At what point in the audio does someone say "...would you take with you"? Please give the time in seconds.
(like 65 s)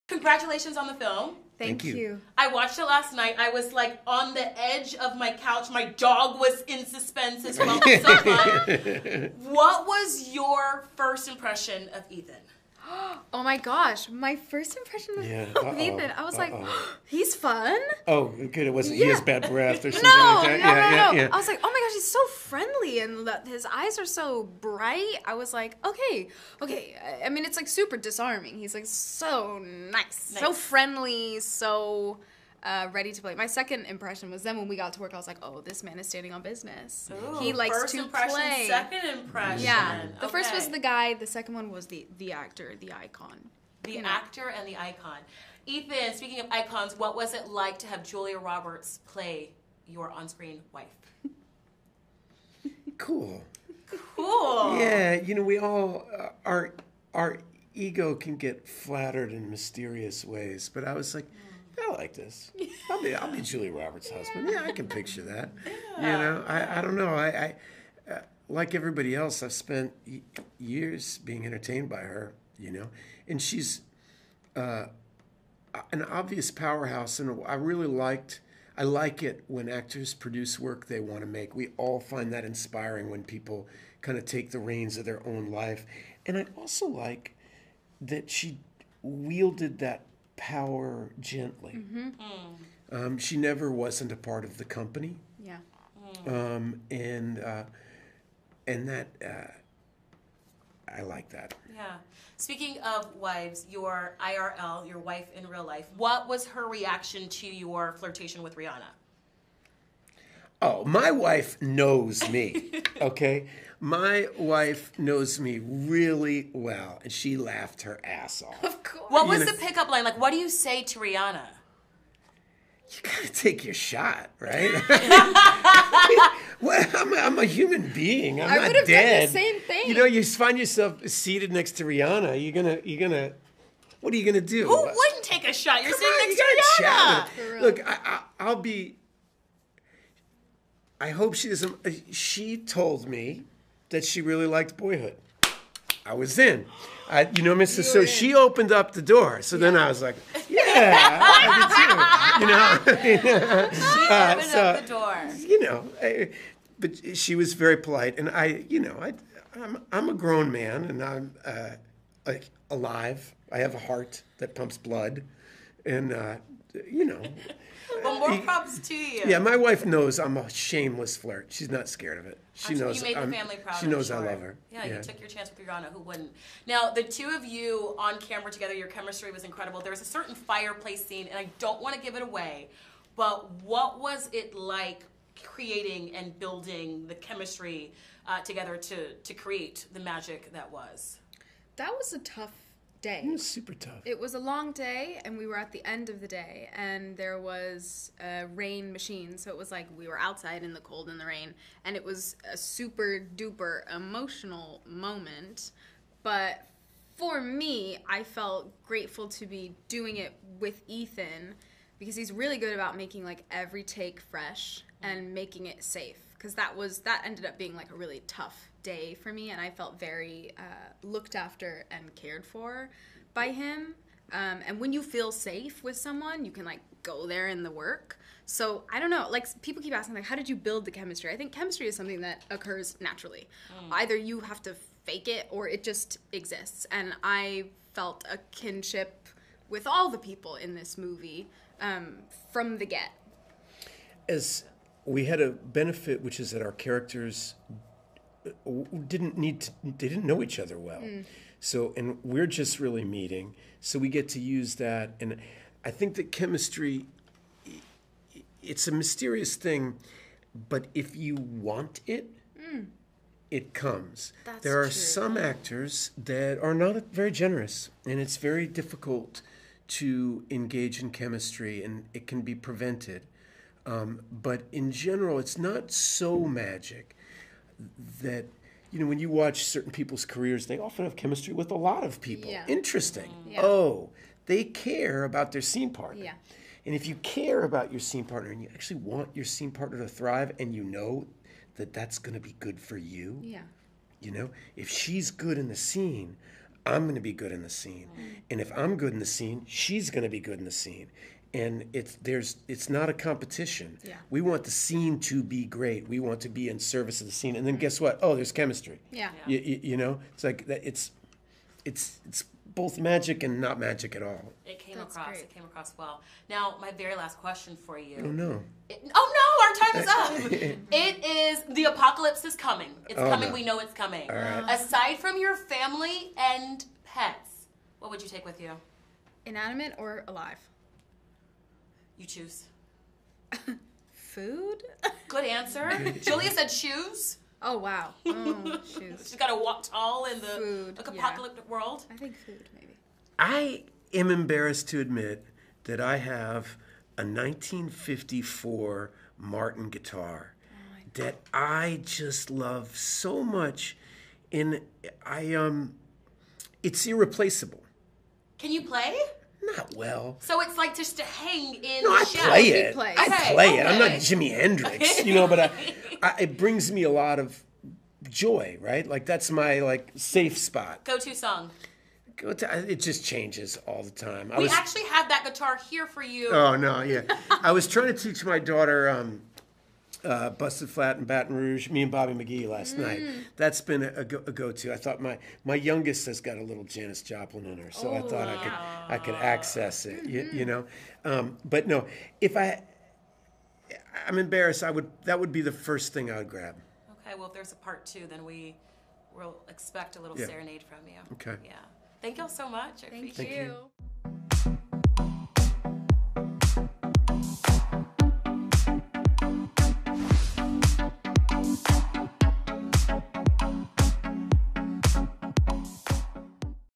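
328 s.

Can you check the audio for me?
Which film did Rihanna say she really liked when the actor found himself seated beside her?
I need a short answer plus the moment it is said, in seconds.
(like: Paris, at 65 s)
Boyhood, at 144 s.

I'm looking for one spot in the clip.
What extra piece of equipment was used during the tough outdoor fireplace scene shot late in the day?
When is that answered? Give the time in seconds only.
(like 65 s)
198 s.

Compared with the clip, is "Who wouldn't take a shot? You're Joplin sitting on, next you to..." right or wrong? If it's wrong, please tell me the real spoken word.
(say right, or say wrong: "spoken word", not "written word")
wrong: "Come", not "Joplin".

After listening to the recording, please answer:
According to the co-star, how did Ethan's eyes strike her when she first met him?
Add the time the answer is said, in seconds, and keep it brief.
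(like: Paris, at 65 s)
Bright, at 24 s.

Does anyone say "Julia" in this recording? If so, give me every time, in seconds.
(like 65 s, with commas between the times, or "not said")
48 s, 63 s, 336 s.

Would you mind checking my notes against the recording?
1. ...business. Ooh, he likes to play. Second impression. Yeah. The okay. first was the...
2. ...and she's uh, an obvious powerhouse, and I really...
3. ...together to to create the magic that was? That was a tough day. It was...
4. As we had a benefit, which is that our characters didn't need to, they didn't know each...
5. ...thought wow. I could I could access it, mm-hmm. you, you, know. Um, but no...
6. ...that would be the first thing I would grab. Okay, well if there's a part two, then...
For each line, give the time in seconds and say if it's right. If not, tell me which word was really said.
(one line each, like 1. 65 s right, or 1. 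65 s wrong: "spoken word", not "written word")
1. 36 s right
2. 73 s right
3. 188 s right
4. 244 s right
5. 388 s right
6. 395 s right.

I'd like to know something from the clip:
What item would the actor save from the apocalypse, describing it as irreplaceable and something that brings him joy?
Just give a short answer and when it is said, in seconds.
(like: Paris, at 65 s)
A 1954 Martin guitar, at 347 s.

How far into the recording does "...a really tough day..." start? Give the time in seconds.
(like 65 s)
217 s.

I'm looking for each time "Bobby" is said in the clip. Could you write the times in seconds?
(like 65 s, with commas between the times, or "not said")
382 s.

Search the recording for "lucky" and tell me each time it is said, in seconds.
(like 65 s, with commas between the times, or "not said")
not said.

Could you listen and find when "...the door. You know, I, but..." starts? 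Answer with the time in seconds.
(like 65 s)
154 s.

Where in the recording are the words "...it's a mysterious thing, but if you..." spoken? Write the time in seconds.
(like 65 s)
258 s.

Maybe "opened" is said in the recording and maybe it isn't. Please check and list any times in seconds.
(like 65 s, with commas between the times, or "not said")
148 s, 154 s.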